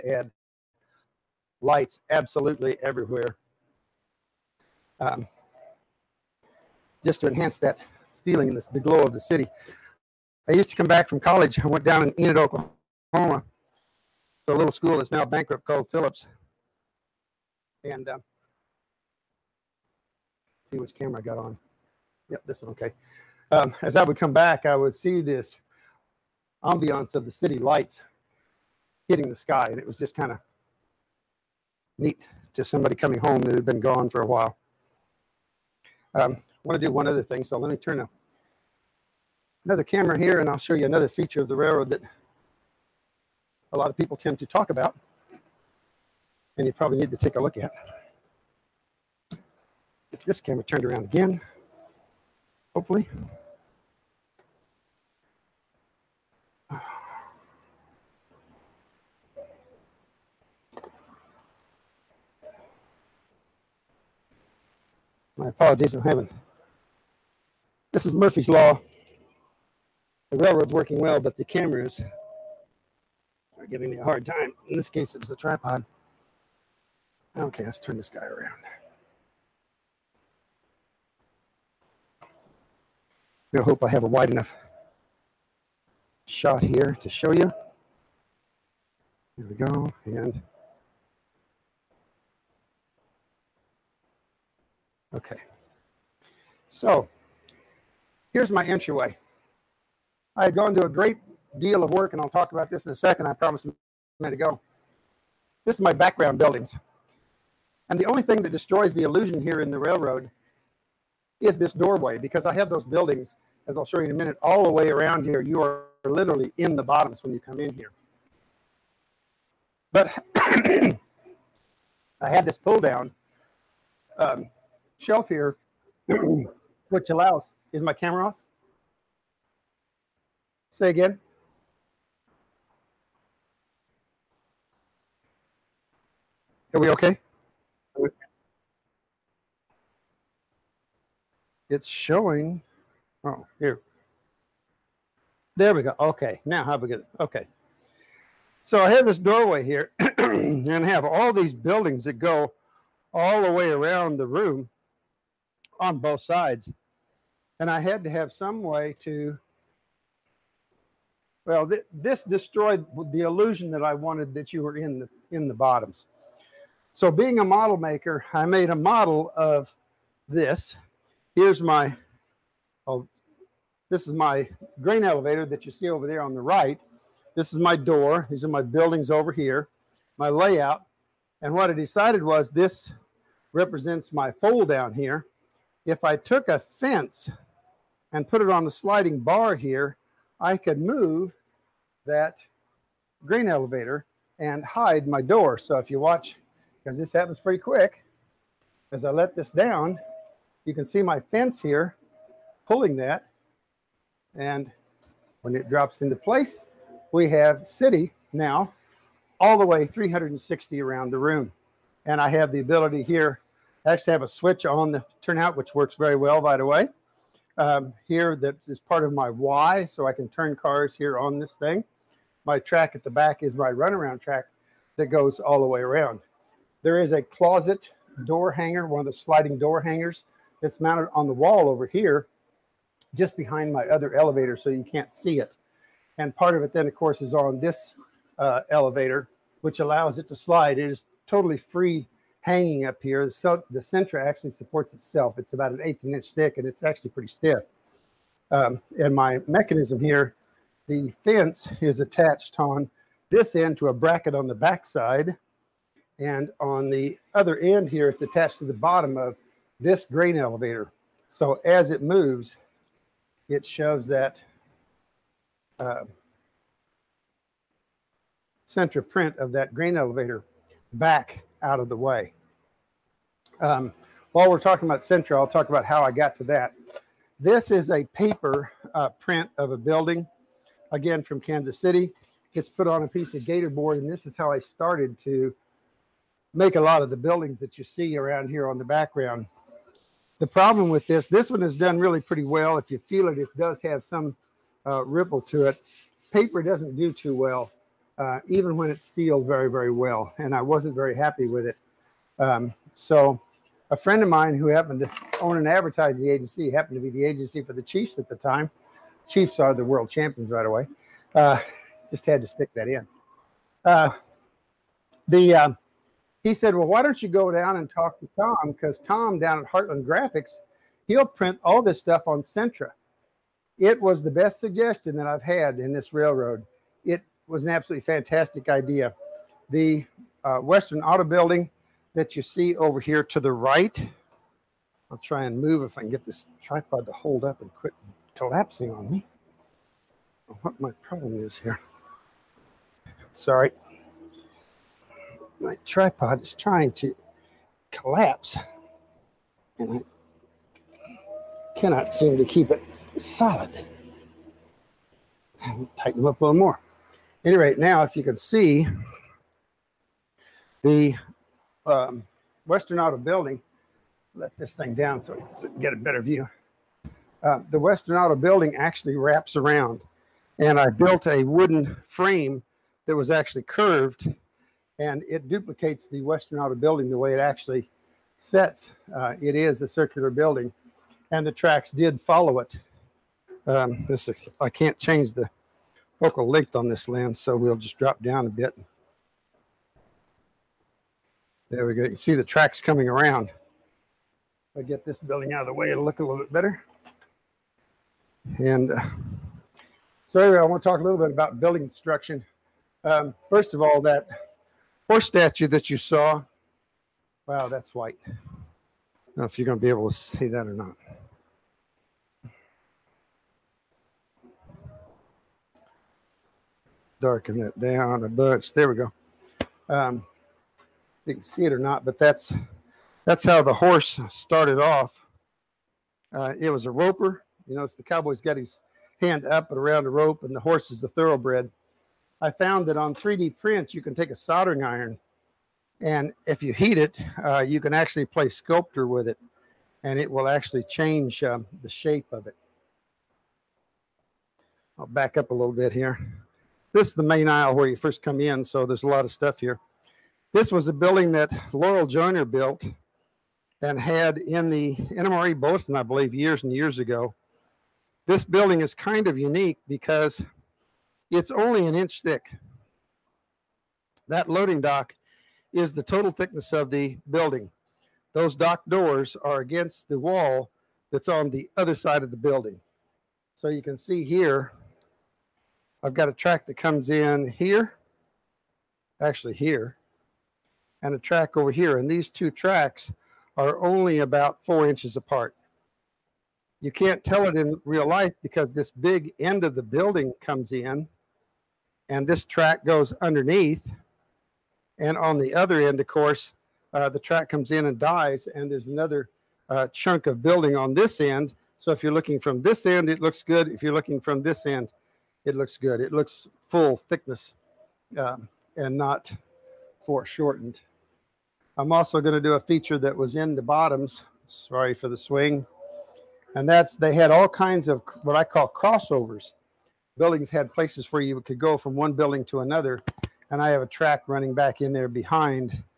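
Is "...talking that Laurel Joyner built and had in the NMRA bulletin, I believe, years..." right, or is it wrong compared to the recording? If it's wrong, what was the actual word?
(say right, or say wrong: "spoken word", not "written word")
wrong: "building", not "talking".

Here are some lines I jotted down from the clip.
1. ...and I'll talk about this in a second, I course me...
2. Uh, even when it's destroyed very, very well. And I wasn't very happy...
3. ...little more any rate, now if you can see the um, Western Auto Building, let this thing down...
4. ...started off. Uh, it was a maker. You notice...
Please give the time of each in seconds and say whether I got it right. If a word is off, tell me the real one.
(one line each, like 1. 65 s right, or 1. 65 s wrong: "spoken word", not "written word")
1. 102 s wrong: "promise", not "course"
2. 298 s wrong: "sealed", not "destroyed"
3. 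356 s right
4. 424 s wrong: "roper", not "maker".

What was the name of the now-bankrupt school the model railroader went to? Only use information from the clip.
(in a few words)
Phillips.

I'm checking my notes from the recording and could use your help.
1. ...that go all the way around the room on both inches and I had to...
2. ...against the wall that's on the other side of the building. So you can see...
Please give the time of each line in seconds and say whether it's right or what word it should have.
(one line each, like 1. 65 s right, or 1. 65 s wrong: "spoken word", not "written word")
1. 152 s wrong: "sides", not "inches"
2. 469 s right.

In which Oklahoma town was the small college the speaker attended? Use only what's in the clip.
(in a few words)
Enid.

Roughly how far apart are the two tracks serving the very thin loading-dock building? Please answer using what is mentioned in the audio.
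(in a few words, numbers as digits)
4 inches.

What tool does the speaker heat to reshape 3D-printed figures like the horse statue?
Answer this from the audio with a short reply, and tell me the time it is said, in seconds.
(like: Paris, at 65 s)
Soldering iron, at 434 s.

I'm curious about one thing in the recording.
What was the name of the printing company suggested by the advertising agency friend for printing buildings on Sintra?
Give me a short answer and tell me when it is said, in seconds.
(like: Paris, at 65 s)
Heartland Graphics, at 319 s.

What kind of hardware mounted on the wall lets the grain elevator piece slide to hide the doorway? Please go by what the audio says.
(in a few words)
Closet door hanger.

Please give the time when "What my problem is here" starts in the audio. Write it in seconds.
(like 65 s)
340 s.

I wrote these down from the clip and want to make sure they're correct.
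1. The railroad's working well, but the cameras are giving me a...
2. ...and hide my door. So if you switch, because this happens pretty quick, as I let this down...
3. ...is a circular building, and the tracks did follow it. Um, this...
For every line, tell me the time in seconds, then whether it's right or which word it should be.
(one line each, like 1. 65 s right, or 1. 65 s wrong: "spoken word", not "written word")
1. 70 s right
2. 194 s wrong: "watch", not "switch"
3. 379 s right.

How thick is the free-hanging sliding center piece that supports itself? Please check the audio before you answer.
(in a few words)
An eighth of an inch.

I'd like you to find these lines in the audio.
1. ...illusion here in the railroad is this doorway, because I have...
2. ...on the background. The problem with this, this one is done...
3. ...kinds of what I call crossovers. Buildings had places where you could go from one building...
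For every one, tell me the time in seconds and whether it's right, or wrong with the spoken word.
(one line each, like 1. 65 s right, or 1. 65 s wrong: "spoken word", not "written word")
1. 109 s right
2. 288 s right
3. 517 s right.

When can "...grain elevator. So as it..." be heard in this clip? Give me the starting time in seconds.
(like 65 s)
260 s.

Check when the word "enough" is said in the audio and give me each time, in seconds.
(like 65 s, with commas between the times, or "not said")
84 s.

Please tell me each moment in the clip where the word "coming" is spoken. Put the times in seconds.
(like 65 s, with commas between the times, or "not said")
32 s, 392 s.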